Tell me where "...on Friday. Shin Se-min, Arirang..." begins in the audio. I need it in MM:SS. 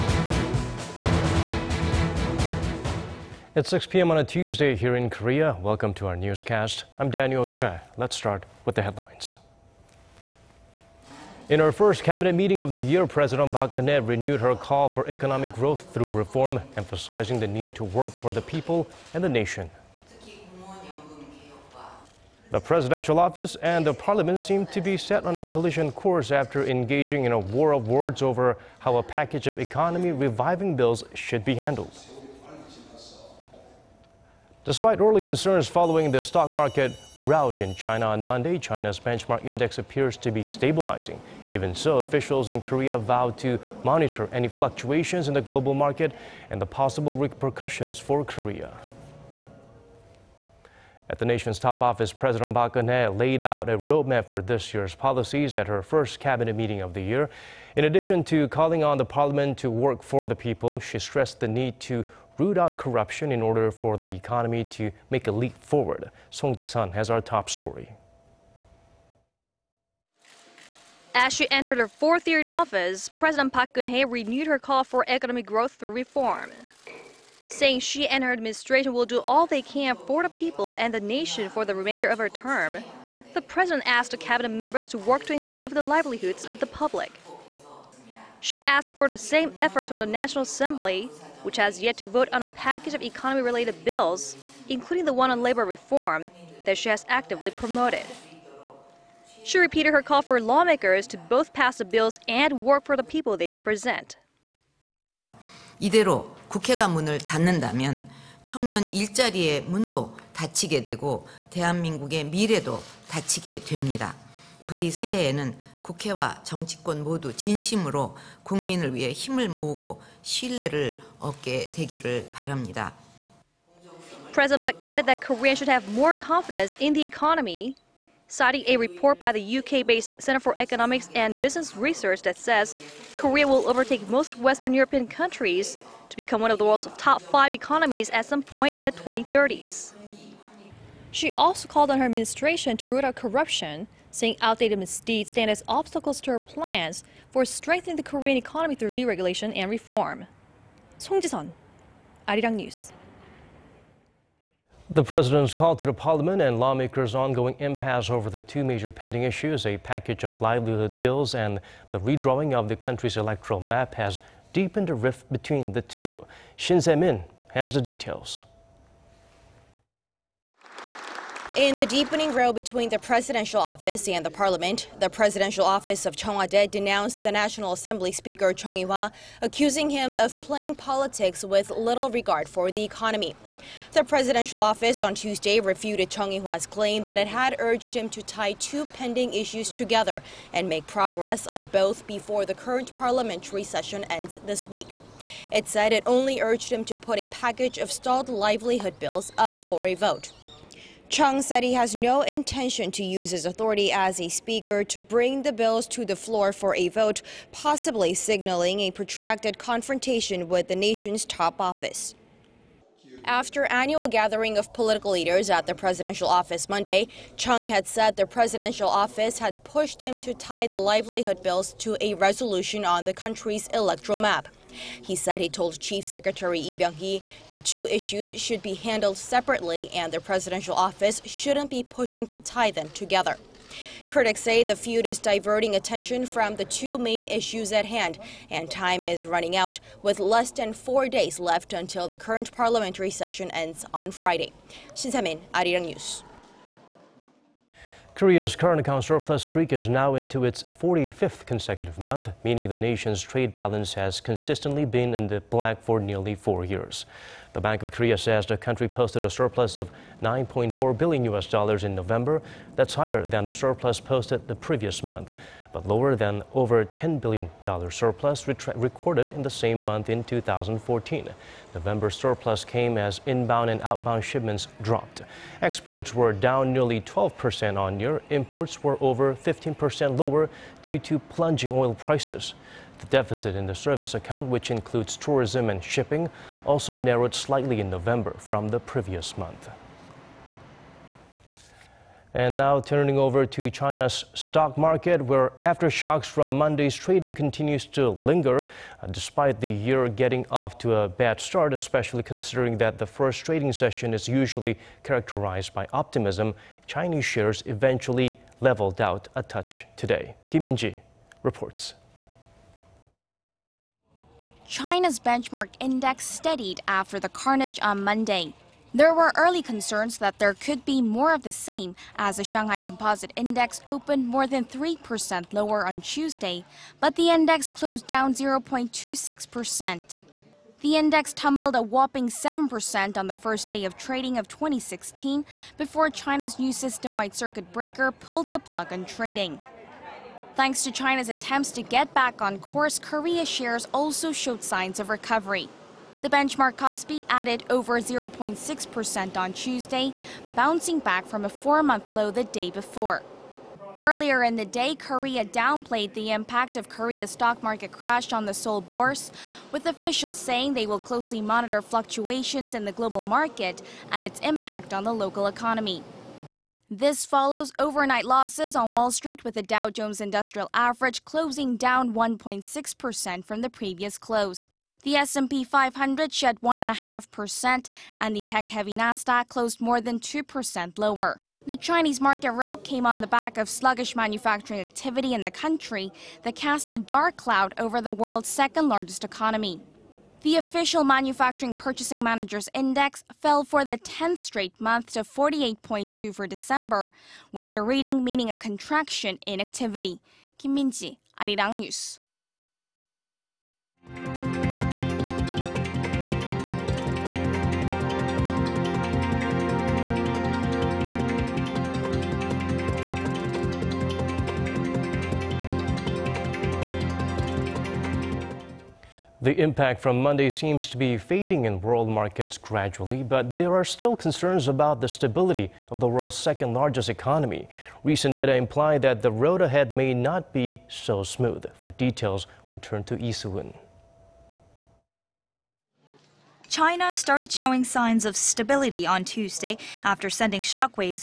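04:03.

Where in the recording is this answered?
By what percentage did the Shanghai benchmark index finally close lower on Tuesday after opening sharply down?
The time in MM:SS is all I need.
05:28.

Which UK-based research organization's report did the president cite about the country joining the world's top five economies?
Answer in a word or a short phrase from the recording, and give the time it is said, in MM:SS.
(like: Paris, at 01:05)
Center for Economics and Business Research, at 02:10.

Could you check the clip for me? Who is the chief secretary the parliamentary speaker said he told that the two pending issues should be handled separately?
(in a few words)
Lee Byung-hee.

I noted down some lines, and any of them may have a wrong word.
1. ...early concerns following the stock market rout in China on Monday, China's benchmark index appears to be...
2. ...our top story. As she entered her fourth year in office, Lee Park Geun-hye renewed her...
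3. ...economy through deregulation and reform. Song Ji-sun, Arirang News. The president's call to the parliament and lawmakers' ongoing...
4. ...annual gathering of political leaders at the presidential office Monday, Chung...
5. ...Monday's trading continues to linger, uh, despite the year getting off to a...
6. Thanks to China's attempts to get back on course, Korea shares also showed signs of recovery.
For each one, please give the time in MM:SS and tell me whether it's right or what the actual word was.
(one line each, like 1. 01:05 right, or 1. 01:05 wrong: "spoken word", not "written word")
1. 00:34 right
2. 01:07 wrong: "President", not "Lee"
3. 02:28 right
4. 03:33 right
5. 04:56 right
6. 05:40 right.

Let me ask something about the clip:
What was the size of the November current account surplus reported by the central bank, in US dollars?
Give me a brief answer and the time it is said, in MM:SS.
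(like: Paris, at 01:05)
9.4 billion US dollars, at 04:20.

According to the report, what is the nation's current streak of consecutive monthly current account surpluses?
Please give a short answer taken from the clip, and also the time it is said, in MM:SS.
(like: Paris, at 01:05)
45th, at 04:10.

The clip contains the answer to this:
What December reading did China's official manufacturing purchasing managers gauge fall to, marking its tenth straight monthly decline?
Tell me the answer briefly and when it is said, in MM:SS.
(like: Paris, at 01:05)
48.2, at 06:35.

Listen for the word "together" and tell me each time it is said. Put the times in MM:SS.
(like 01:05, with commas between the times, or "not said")
03:09, 03:52.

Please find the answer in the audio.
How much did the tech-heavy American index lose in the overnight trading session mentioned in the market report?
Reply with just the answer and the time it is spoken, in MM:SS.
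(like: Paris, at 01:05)
more than 2%, at 06:19.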